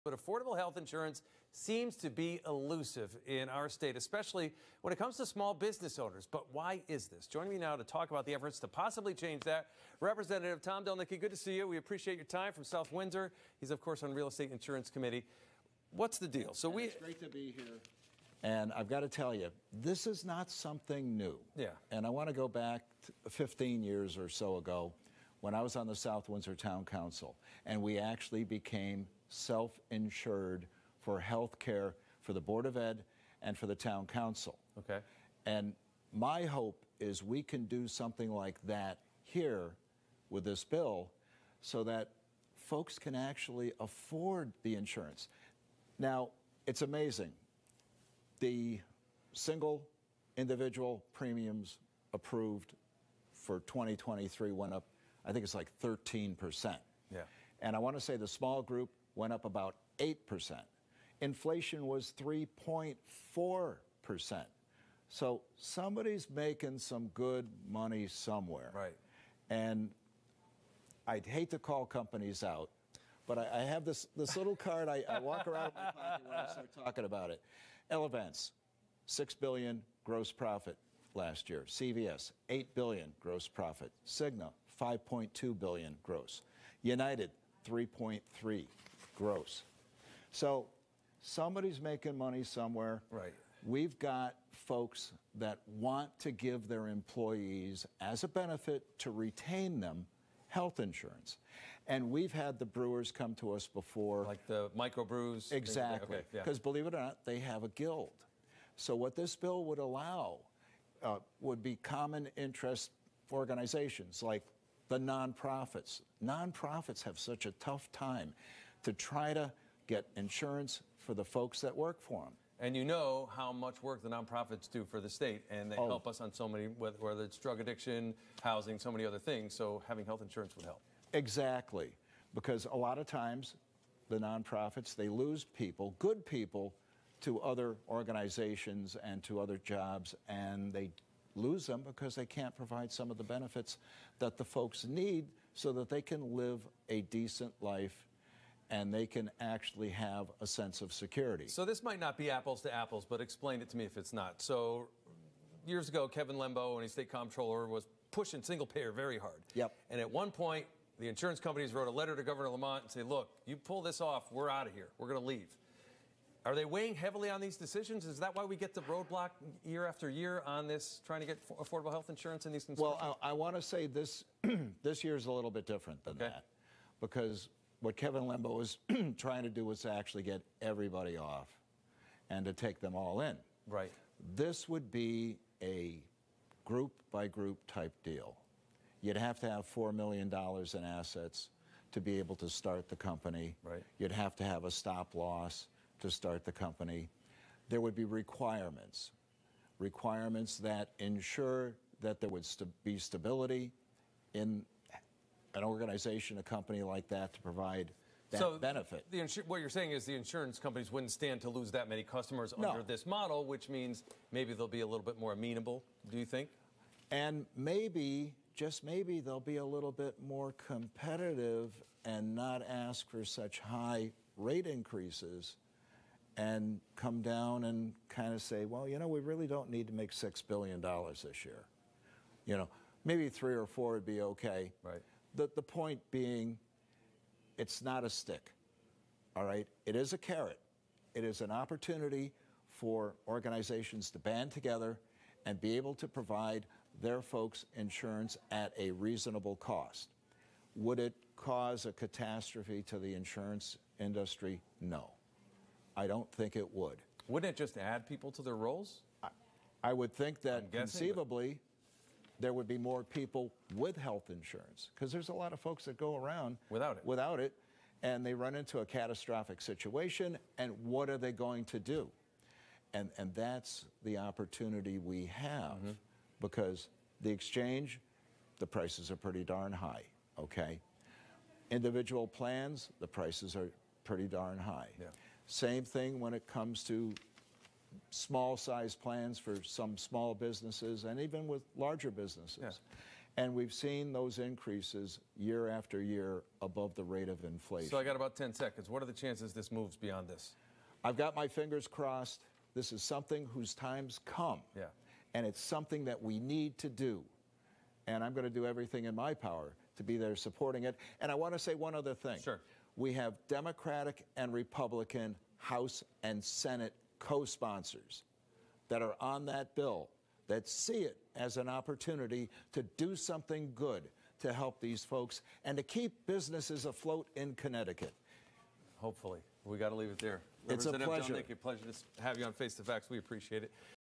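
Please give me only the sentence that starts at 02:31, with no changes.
So this might not be apples to apples, but explain it to me if it's not.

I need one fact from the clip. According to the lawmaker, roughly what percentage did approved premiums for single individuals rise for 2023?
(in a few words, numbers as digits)
13%.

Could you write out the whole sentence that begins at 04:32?
And and that's the opportunity we have mm -hmm.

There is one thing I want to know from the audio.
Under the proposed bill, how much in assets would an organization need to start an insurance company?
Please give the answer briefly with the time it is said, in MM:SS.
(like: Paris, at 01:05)
$4 million, at 03:09.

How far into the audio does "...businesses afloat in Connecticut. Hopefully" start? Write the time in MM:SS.
05:26.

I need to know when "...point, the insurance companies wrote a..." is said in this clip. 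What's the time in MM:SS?
02:40.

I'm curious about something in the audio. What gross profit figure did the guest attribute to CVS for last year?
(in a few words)
8 billion.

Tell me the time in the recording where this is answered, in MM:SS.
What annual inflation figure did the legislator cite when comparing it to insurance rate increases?
01:02.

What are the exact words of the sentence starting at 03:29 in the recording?
The insu- what you're saying is the insurance companies wouldn't stand to lose that many customers no.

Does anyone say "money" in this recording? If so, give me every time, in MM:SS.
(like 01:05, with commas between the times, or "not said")
01:07, 01:32.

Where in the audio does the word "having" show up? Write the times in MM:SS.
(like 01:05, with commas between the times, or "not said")
02:09.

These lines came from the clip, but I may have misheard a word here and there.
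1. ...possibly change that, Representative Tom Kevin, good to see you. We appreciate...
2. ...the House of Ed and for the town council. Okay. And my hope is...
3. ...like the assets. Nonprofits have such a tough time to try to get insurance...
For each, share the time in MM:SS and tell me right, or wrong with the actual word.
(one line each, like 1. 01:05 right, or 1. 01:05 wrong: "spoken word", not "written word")
1. 00:08 wrong: "Delnicki", not "Kevin"
2. 00:32 wrong: "Board", not "House"
3. 01:54 wrong: "nonprofits", not "assets".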